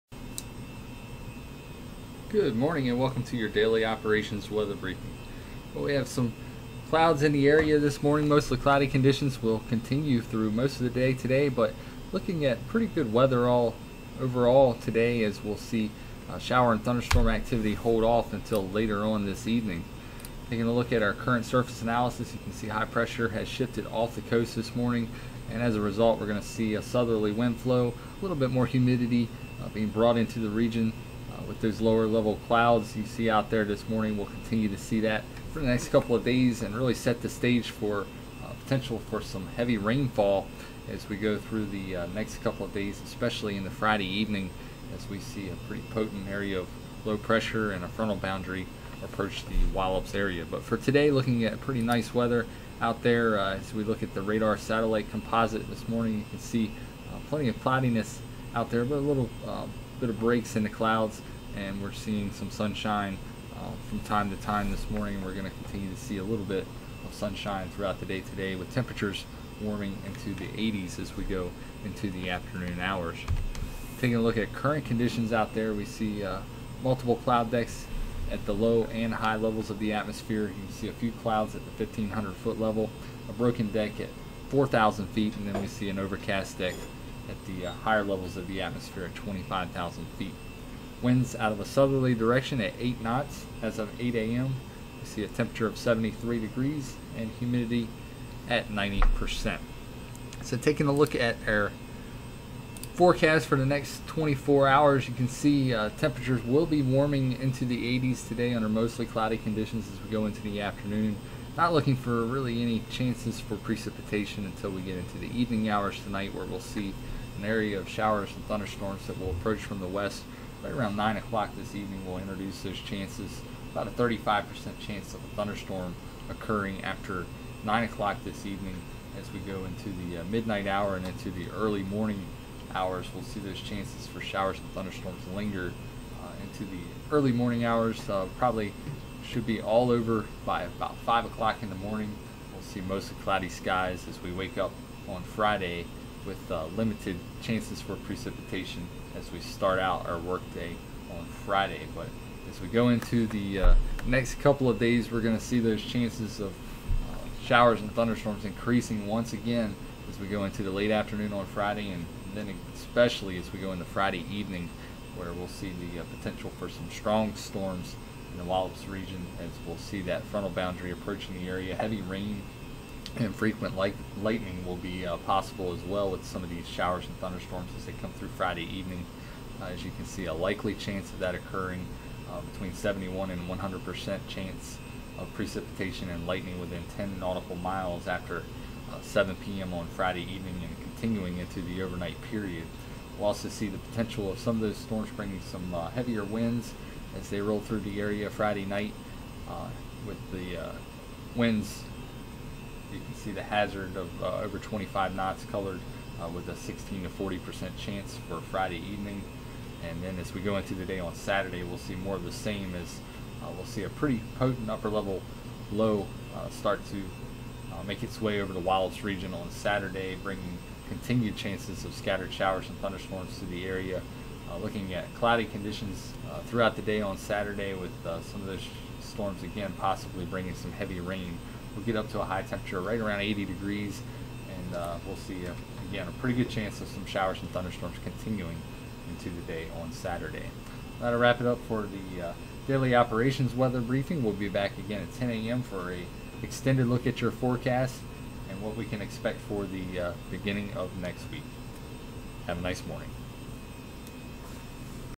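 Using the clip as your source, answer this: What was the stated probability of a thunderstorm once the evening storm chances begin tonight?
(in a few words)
35%.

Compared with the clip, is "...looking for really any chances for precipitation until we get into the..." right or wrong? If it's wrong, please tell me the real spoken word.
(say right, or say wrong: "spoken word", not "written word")
right.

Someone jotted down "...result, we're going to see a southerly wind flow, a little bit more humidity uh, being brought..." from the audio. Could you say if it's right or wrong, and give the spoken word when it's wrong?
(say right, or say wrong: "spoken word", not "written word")
right.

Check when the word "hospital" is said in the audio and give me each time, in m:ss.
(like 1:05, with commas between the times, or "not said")
not said.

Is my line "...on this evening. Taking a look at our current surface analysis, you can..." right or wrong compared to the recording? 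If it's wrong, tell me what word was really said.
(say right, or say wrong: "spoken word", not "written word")
right.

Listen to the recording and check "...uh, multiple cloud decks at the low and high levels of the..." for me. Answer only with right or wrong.
right.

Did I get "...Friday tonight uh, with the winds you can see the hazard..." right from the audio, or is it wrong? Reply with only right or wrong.
wrong.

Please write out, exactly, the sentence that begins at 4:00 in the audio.
That'll wrap it up for the uh, daily operations weather briefing.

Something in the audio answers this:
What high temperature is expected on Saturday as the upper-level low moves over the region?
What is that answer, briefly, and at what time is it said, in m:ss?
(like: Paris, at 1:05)
80 degrees, at 3:53.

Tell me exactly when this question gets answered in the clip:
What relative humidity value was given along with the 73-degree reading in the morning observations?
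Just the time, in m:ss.
1:38.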